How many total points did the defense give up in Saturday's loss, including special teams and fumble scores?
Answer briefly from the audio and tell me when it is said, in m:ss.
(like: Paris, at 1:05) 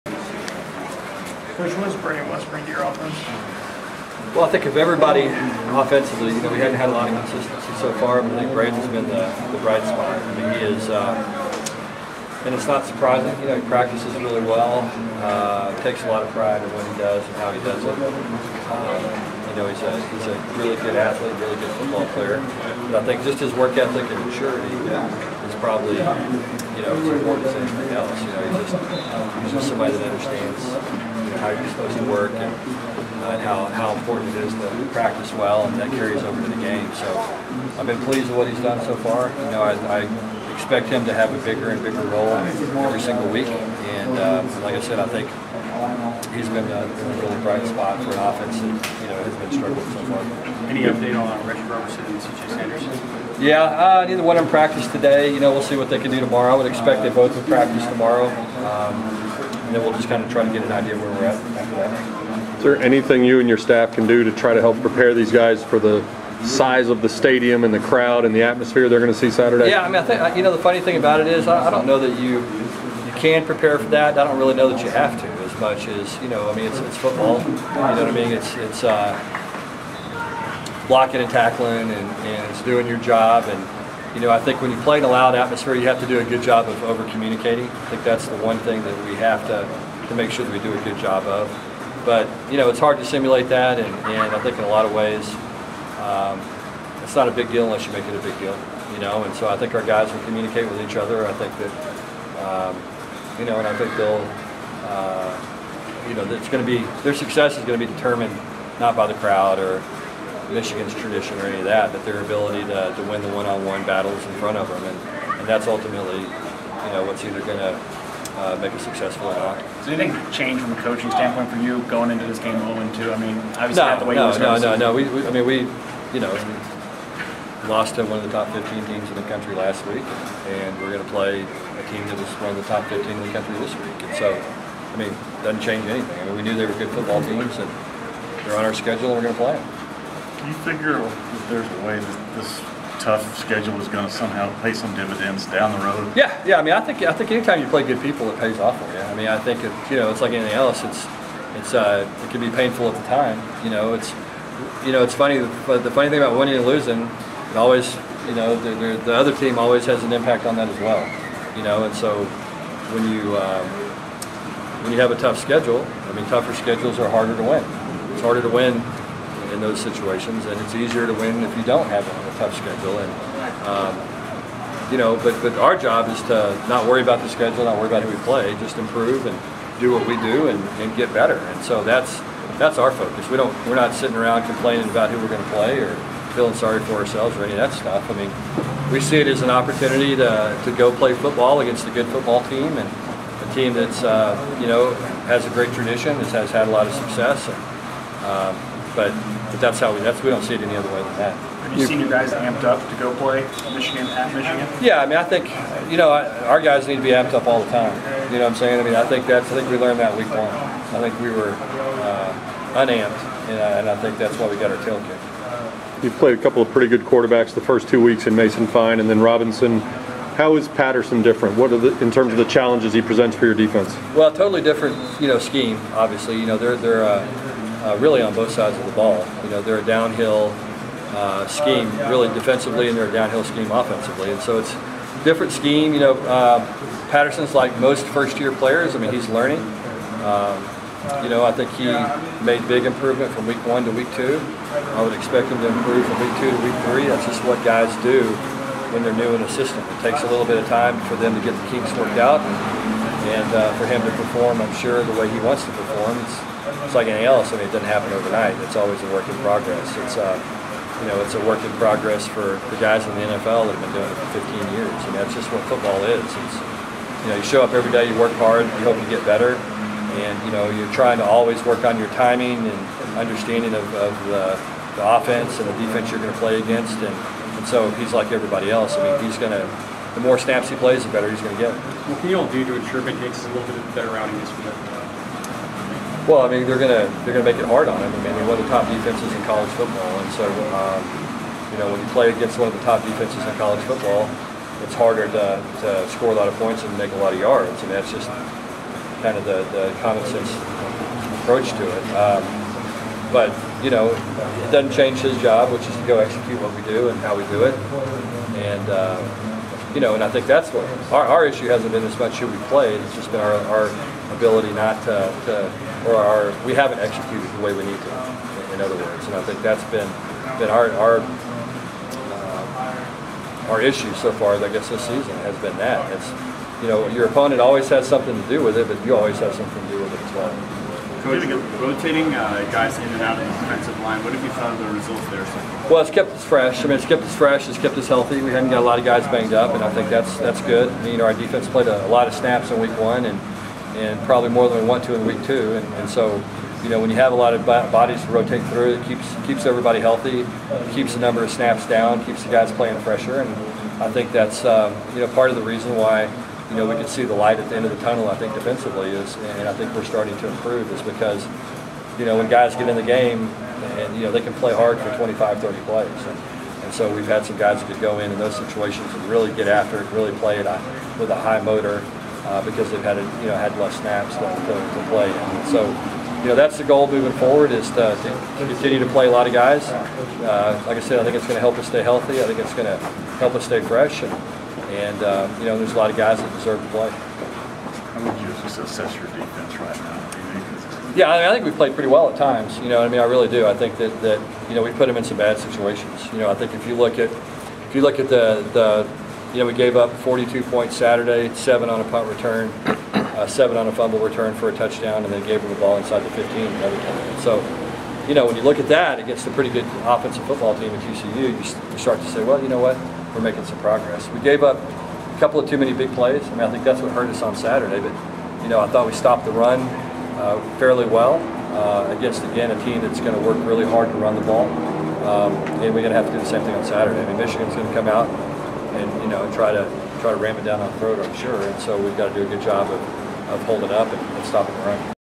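42, at 6:40.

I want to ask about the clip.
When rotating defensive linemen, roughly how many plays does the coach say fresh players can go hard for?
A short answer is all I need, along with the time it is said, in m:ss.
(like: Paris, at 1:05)
25 to 30, at 6:05.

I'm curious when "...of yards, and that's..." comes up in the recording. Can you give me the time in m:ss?
4:57.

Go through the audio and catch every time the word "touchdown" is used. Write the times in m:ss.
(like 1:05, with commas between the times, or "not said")
6:44.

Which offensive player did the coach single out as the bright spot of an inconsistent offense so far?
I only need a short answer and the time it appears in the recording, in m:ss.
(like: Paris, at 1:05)
Braeden West, at 0:01.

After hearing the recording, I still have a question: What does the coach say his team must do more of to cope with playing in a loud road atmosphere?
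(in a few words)
Over communicating.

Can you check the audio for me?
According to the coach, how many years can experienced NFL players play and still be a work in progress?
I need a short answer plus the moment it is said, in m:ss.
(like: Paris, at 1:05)
15, at 4:24.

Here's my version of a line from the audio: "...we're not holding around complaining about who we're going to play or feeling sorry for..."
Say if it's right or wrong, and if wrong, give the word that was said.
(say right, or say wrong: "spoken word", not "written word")
wrong: "sitting", not "holding".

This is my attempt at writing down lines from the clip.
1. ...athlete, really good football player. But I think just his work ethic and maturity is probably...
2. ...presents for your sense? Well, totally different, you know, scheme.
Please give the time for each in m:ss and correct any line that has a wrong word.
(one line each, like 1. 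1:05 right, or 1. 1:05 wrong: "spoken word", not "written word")
1. 0:20 right
2. 3:43 wrong: "defense", not "sense".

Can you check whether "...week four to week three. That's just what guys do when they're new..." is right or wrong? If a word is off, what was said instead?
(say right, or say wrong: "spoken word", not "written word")
wrong: "two", not "four".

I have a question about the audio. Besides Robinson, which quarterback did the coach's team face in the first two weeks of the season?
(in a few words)
Mason Fine.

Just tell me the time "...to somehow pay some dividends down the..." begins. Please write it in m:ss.
2:24.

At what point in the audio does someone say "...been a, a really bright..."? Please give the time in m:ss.
0:46.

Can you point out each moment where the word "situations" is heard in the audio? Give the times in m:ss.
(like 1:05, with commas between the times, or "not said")
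2:49, 6:08, 6:35.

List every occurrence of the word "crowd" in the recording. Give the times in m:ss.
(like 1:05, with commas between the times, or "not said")
1:07, 1:49.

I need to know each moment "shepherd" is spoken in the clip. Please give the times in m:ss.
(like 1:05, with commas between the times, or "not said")
not said.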